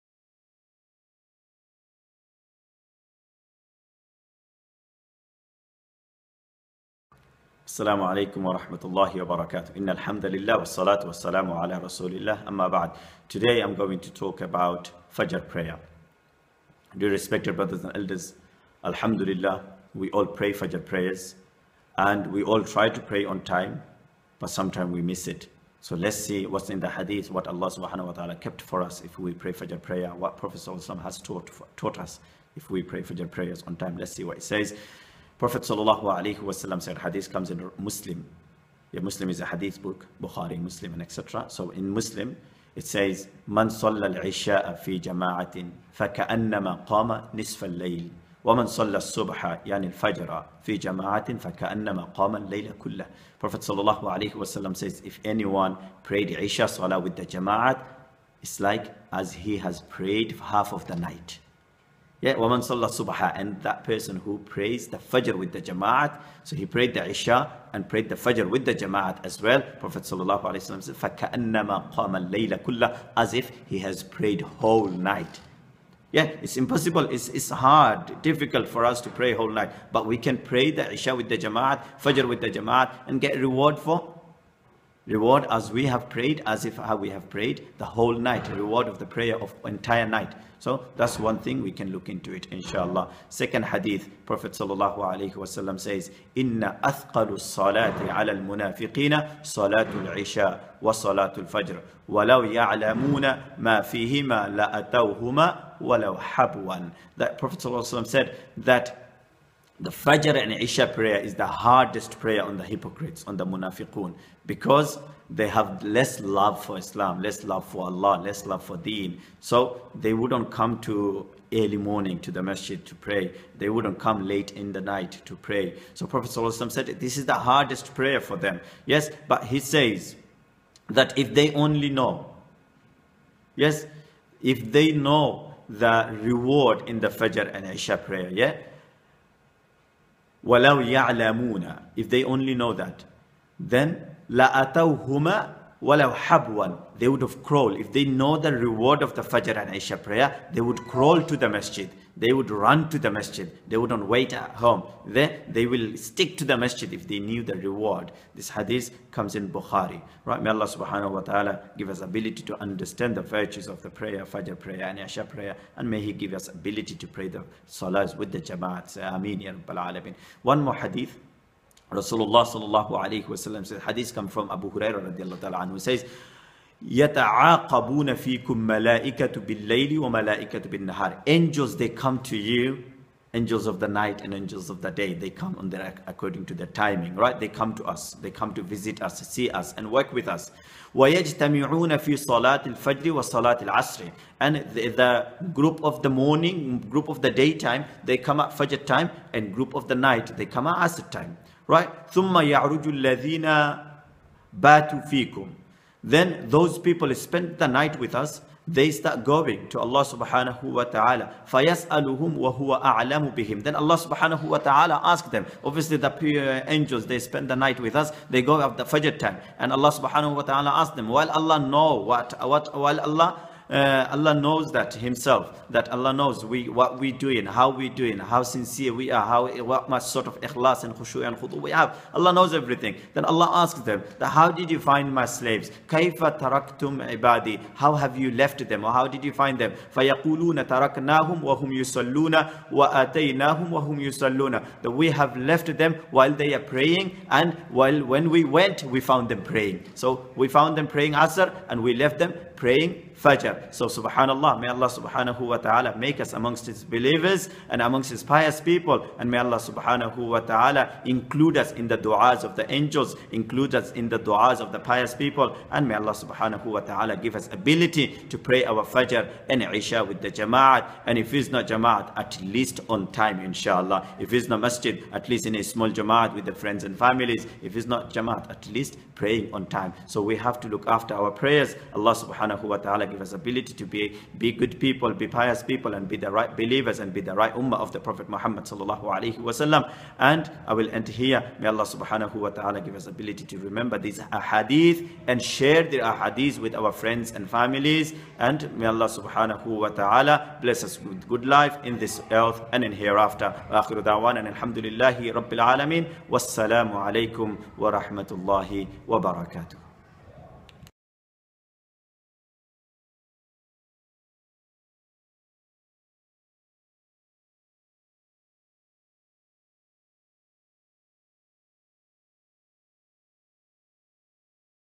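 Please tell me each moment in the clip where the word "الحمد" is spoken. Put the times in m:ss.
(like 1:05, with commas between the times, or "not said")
0:09, 5:04.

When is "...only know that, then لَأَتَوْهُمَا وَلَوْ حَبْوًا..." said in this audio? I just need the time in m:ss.
2:22.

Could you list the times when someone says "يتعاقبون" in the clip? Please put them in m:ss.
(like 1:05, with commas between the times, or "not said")
2:56.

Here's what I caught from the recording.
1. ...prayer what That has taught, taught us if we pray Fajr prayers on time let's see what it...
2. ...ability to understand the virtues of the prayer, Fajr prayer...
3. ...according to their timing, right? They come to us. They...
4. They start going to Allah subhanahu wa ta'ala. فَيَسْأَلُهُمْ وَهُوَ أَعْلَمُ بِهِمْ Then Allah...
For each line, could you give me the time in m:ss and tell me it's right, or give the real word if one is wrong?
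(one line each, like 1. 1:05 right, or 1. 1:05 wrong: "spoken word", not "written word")
1. 0:29 wrong: "Prophet", not "That"
2. 2:42 right
3. 3:06 right
4. 3:28 right.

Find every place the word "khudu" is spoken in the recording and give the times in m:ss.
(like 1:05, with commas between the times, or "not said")
3:51.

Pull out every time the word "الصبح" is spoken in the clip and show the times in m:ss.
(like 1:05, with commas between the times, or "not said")
0:48, 1:02.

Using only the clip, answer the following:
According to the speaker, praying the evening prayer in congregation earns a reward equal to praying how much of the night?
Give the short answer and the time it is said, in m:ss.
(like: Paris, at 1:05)
Half of the night, at 1:00.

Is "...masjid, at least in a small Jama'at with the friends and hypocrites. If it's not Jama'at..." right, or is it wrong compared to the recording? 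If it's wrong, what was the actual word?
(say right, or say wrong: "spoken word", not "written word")
wrong: "families", not "hypocrites".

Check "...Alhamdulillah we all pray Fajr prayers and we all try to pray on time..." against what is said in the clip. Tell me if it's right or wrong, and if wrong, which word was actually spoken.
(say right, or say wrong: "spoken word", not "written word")
right.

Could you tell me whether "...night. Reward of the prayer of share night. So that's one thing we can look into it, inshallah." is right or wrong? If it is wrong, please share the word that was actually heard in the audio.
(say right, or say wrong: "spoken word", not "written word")
wrong: "entire", not "share".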